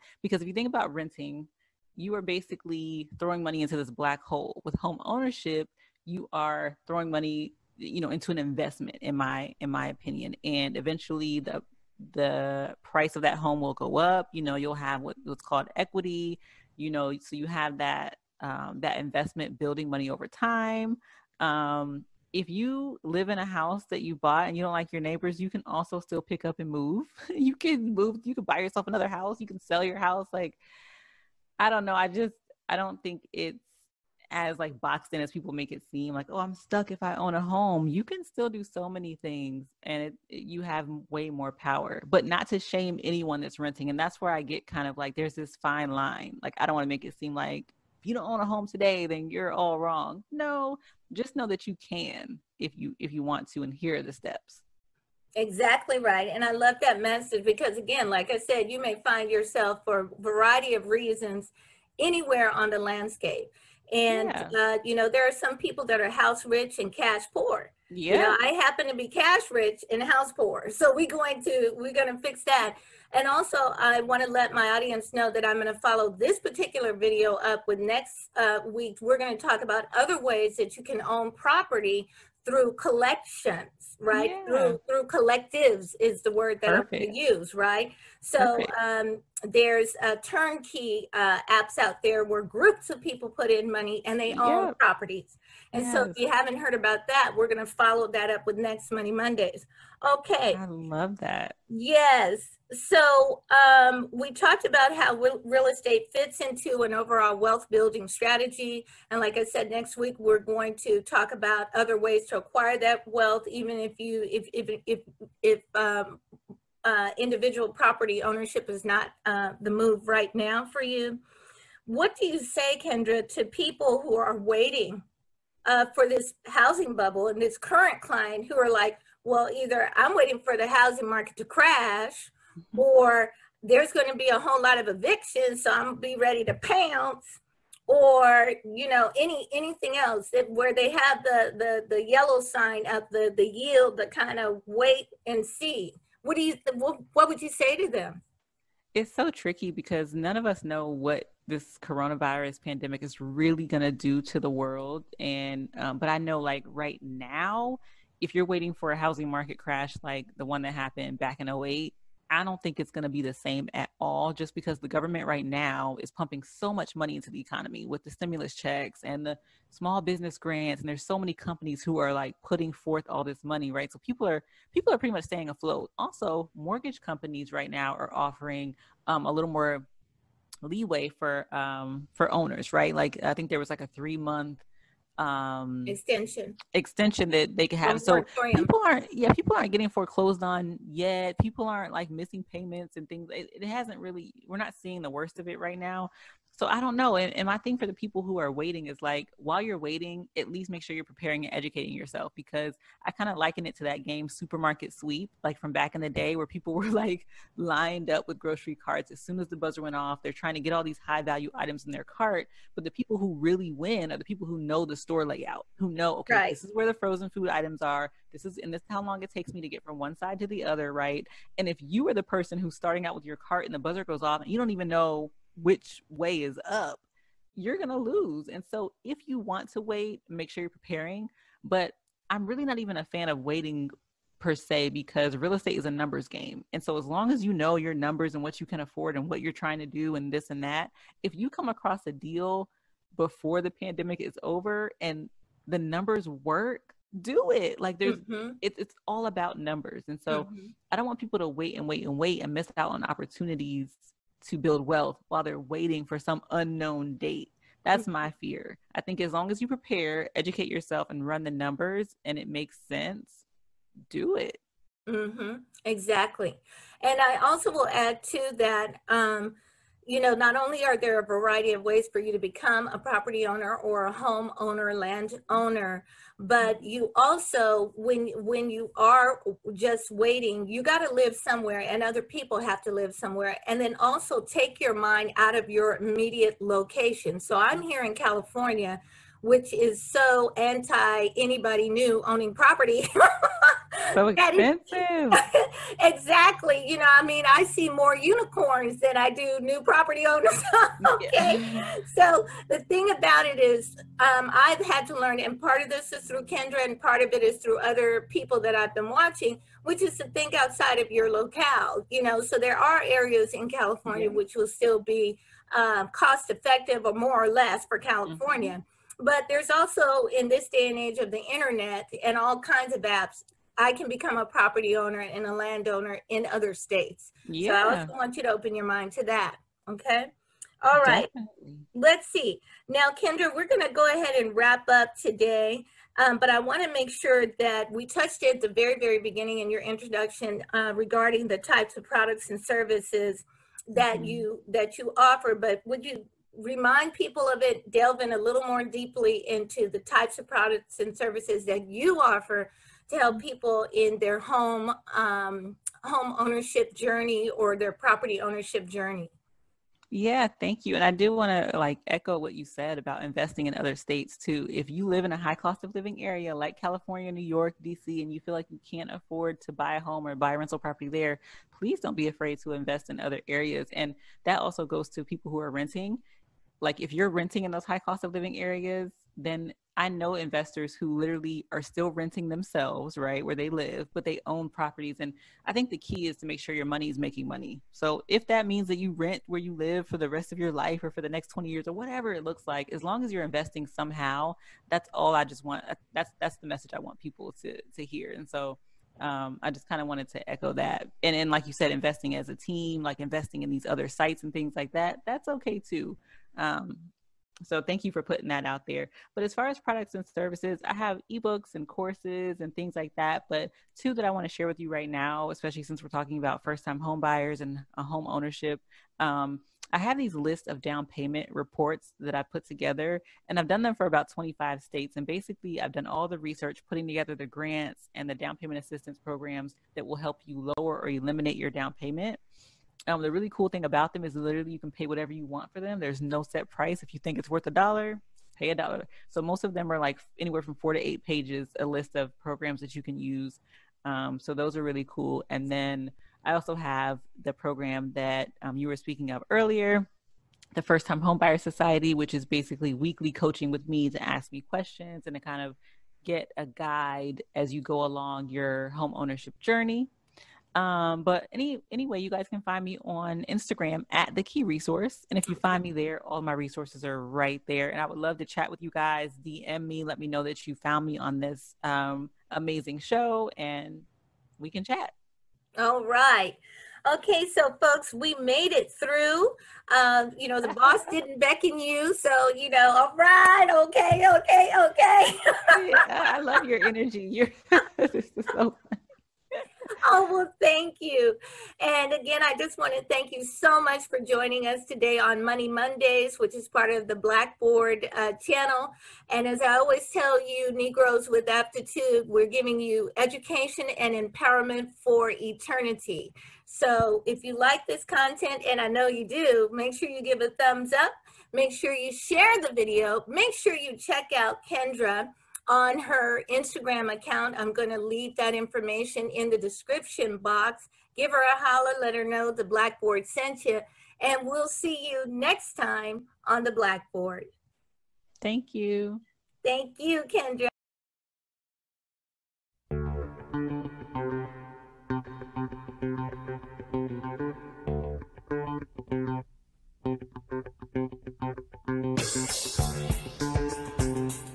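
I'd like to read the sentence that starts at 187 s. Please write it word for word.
So people aren't yeah people aren't getting foreclosed on yet.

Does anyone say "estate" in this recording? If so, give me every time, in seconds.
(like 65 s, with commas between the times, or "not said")
105 s, 235 s.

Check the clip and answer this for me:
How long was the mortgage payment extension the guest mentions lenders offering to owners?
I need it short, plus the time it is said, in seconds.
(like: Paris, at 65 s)
three month, at 183 s.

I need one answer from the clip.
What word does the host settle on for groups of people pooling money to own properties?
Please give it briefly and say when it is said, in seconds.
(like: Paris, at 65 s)
collectives, at 85 s.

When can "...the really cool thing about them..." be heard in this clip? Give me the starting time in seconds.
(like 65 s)
433 s.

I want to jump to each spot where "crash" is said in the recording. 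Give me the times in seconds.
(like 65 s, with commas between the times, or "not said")
131 s, 159 s.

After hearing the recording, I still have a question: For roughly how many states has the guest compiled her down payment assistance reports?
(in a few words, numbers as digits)
25.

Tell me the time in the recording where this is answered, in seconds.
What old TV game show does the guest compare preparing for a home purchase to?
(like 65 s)
204 s.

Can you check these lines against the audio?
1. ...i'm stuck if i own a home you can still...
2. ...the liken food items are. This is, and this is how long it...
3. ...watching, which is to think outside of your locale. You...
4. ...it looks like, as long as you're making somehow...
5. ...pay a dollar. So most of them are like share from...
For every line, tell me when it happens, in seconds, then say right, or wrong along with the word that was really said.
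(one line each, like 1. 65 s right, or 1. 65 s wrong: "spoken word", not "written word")
1. 36 s right
2. 216 s wrong: "frozen", not "liken"
3. 309 s right
4. 392 s wrong: "investing", not "making"
5. 438 s wrong: "anywhere", not "share".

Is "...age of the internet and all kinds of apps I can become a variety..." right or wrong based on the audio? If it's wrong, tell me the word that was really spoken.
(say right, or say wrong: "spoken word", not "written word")
wrong: "property", not "variety".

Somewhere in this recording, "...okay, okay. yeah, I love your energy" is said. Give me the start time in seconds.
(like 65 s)
484 s.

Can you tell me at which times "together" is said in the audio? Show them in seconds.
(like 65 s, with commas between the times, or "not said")
422 s, 427 s.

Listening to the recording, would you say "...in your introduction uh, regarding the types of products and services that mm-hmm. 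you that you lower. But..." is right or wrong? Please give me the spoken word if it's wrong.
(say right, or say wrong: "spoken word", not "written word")
wrong: "offer", not "lower".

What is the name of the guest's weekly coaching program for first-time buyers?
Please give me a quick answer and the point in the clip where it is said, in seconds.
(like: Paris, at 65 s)
First Time Homebuyer Society, at 450 s.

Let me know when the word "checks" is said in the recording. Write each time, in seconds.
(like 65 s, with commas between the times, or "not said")
168 s, 513 s.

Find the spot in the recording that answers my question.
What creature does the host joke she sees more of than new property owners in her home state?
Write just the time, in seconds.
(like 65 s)
298 s.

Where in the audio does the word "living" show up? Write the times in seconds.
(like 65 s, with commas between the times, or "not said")
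365 s, 378 s.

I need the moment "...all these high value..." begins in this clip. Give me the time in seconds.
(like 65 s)
210 s.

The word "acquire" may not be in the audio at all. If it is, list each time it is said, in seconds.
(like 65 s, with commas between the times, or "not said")
112 s.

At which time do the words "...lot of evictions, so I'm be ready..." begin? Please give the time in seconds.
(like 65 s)
134 s.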